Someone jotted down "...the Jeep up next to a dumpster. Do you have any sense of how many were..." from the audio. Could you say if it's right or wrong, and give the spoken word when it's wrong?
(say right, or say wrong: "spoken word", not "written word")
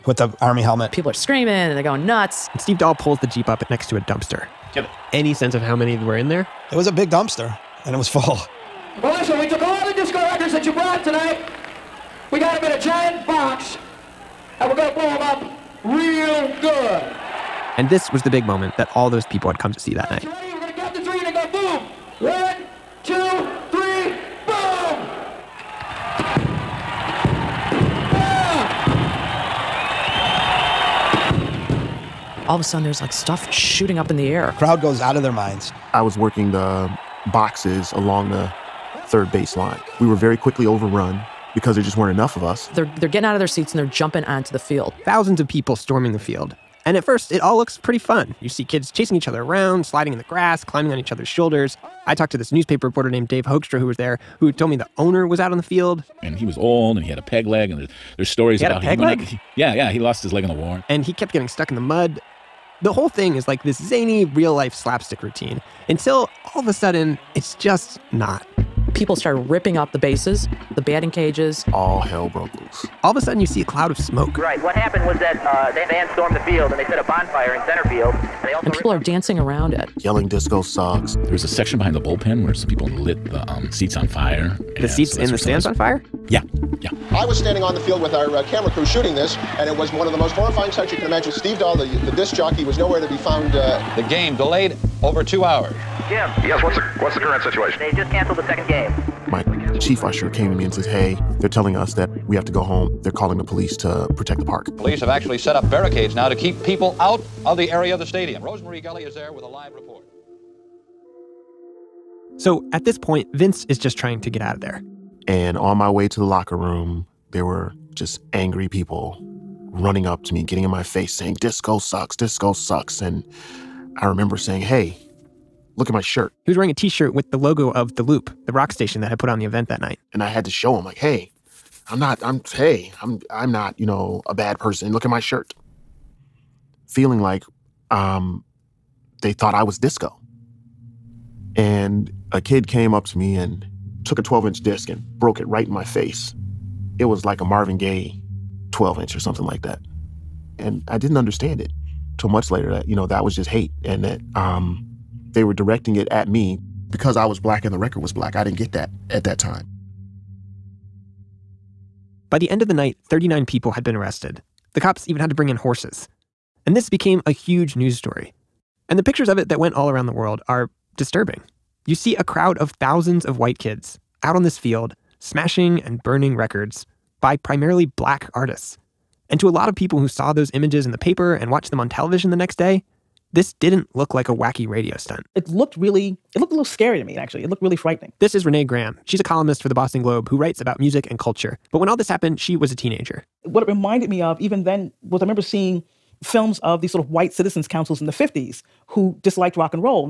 right.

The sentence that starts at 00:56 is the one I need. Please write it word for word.
And he was old and he had a peg leg, and there's, there's stories he about a peg leg?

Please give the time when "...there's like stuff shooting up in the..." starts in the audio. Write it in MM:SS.
00:32.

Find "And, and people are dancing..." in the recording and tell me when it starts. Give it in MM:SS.
01:18.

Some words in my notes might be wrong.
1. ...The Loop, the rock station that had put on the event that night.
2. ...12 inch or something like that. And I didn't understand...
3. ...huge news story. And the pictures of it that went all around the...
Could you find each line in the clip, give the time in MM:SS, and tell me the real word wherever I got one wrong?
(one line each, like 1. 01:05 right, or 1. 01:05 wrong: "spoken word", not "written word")
1. 02:07 right
2. 02:28 right
3. 02:47 right.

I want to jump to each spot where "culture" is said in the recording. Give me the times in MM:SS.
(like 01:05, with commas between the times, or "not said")
03:11.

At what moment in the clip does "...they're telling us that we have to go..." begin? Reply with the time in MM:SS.
01:41.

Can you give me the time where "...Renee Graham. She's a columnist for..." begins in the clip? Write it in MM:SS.
03:08.